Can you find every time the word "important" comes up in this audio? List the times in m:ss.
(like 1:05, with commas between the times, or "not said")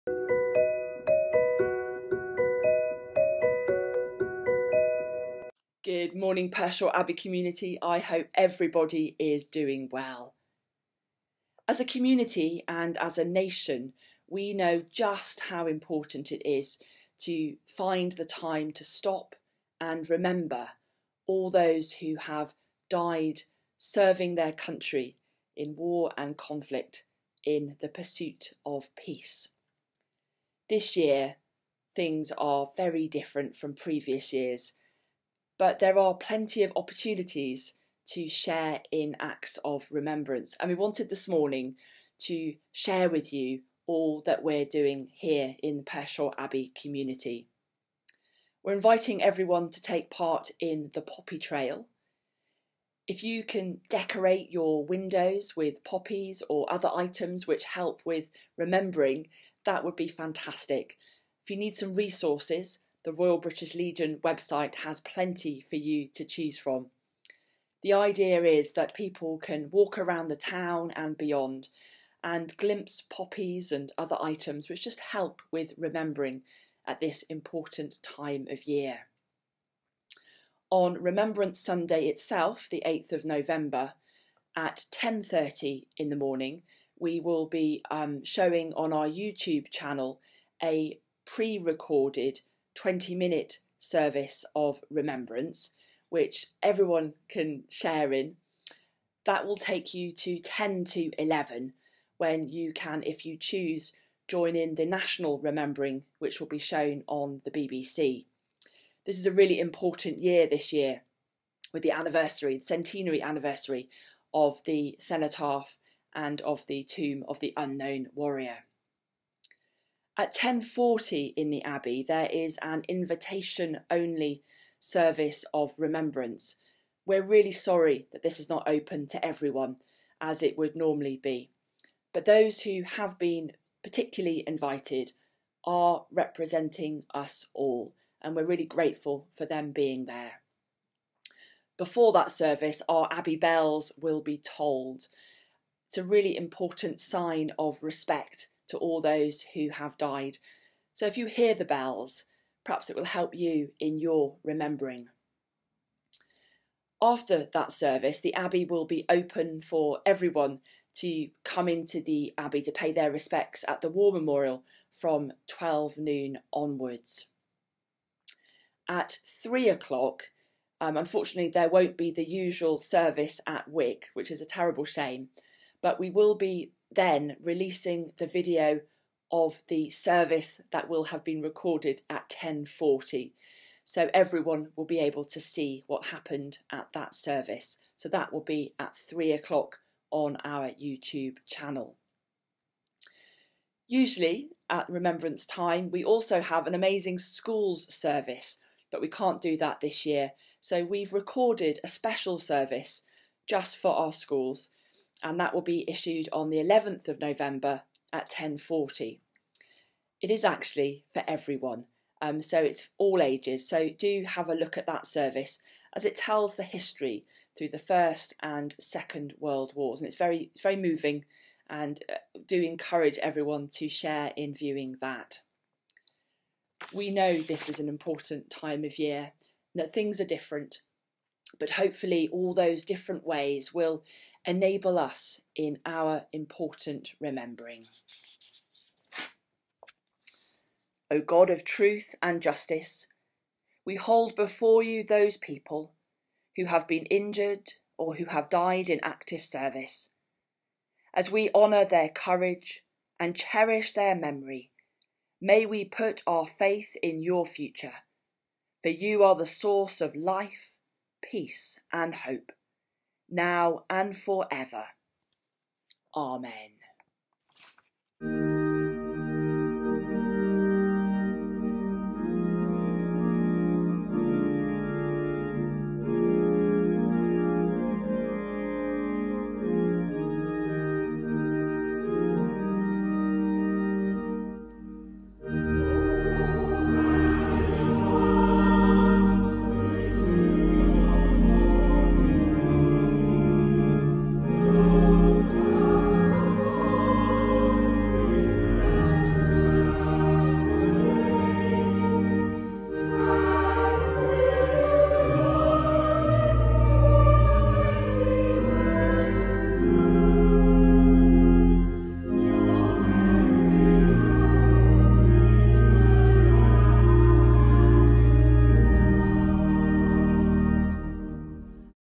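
0:15, 1:17, 1:49, 2:26, 3:47, 3:56.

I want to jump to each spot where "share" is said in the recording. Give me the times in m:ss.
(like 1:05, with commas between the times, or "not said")
0:38, 0:42, 1:37, 3:43.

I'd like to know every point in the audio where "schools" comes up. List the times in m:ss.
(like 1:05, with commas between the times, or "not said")
3:17, 3:24.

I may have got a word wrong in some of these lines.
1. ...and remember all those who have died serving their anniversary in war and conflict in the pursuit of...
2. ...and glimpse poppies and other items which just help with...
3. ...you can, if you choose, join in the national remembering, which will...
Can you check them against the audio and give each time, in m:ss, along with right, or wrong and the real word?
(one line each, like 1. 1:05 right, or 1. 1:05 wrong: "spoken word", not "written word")
1. 0:19 wrong: "country", not "anniversary"
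2. 1:12 right
3. 1:42 right.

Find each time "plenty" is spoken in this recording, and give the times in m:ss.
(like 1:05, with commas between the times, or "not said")
0:36, 1:05.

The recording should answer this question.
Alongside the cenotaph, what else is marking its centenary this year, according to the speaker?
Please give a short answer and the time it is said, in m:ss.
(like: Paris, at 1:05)
Tomb of the Unknown Warrior, at 1:56.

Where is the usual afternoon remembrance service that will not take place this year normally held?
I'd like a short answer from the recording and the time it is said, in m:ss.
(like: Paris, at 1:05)
Wick, at 2:53.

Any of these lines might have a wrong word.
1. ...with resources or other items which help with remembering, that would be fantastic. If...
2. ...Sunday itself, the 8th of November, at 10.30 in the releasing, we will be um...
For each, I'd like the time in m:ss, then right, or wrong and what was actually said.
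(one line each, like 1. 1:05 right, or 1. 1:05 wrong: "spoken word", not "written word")
1. 0:55 wrong: "poppies", not "resources"
2. 1:21 wrong: "morning", not "releasing".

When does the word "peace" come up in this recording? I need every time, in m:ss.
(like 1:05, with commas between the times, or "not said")
0:28, 4:21.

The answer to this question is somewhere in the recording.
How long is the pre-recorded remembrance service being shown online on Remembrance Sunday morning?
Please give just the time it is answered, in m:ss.
1:32.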